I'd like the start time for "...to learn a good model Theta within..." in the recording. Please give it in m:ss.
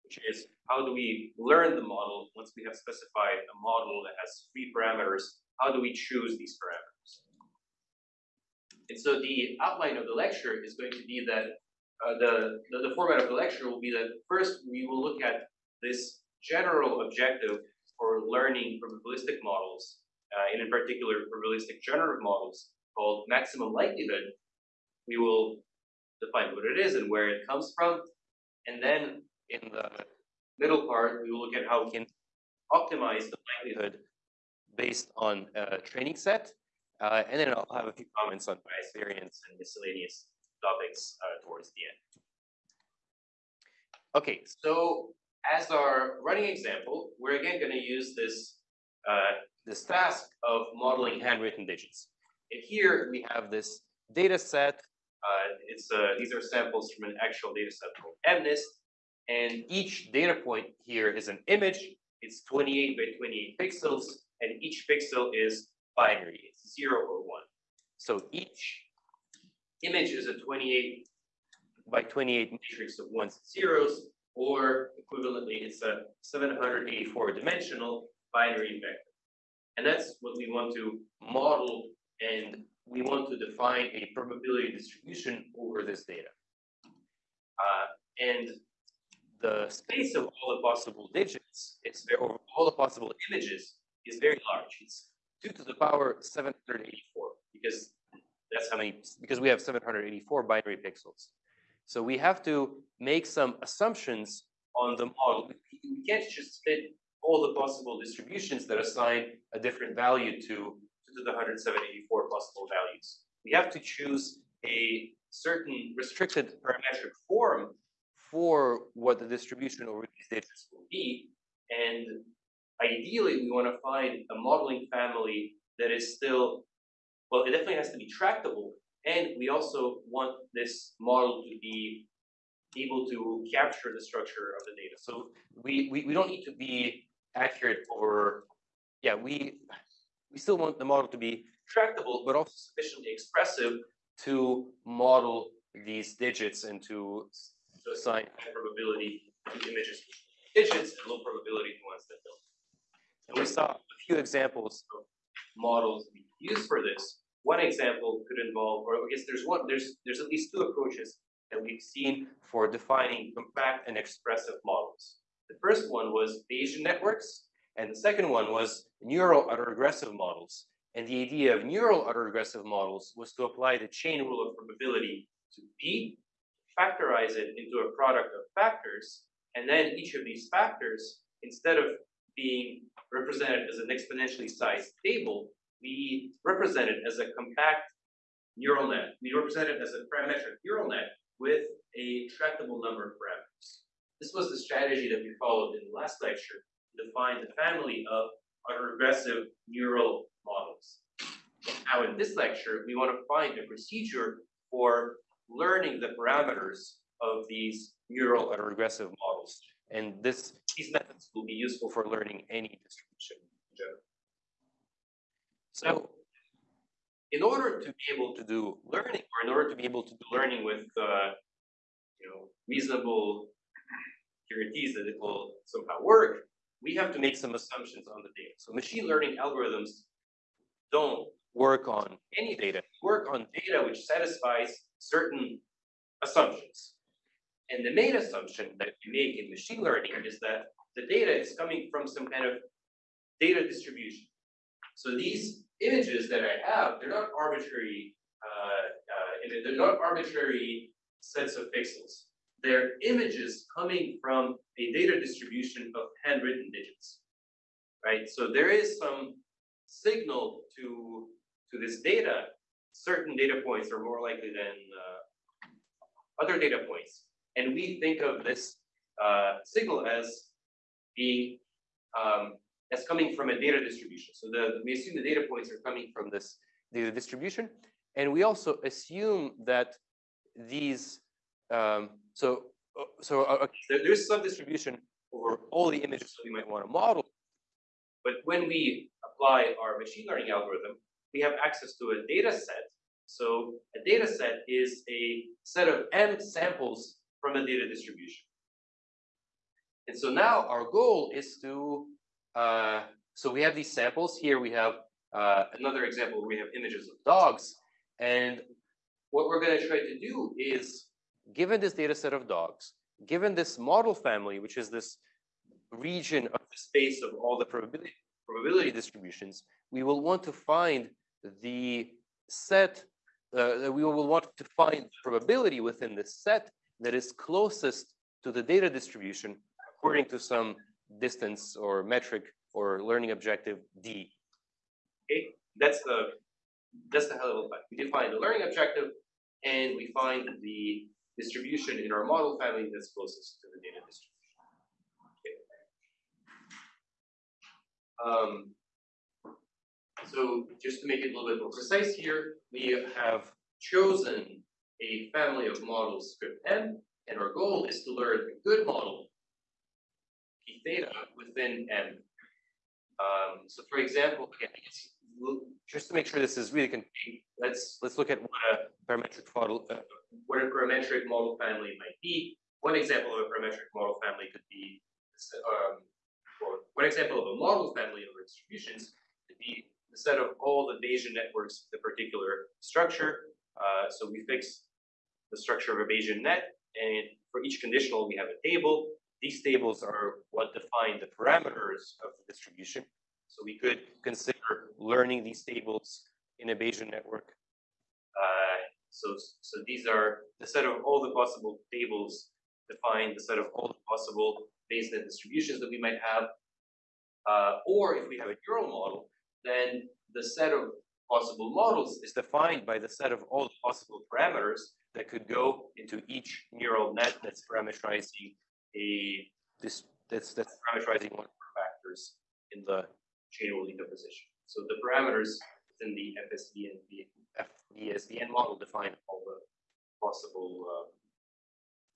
5:58.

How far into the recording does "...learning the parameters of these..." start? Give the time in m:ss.
3:25.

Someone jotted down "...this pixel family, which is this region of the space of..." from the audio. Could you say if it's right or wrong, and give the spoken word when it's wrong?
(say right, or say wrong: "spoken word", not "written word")
wrong: "model", not "pixel".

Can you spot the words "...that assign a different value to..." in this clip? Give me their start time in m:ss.
1:48.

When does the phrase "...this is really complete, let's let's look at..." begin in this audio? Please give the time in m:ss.
6:06.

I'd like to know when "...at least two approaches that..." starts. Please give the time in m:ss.
2:40.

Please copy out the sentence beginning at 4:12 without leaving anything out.
They're images coming from a data distribution of handwritten digits, right?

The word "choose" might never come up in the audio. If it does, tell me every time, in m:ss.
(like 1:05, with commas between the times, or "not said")
0:05, 1:53.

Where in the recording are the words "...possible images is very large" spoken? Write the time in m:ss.
1:32.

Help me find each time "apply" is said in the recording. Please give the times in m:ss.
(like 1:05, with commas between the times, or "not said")
2:53, 4:49.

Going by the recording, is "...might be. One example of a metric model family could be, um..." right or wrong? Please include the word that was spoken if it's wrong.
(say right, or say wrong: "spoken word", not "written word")
wrong: "parametric", not "metric".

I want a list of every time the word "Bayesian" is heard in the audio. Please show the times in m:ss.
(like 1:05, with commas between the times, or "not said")
2:46, 6:21, 6:26, 6:36, 6:44.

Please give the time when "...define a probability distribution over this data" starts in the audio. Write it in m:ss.
1:23.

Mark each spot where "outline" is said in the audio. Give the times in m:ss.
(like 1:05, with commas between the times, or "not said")
0:09.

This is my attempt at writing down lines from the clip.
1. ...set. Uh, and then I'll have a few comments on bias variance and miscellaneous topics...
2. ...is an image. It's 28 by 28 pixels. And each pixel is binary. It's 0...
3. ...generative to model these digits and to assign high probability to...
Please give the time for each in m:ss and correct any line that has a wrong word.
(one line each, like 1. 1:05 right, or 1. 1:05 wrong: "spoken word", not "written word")
1. 0:36 right
2. 1:01 right
3. 2:23 wrong: "expressive", not "generative".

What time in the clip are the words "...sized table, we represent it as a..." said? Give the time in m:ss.
3:04.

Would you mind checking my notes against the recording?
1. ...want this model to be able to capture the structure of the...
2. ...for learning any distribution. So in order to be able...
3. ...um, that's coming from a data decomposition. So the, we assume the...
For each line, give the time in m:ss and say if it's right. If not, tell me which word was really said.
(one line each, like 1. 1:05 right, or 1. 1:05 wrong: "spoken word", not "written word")
1. 2:10 right
2. 3:31 right
3. 4:32 wrong: "distribution", not "decomposition".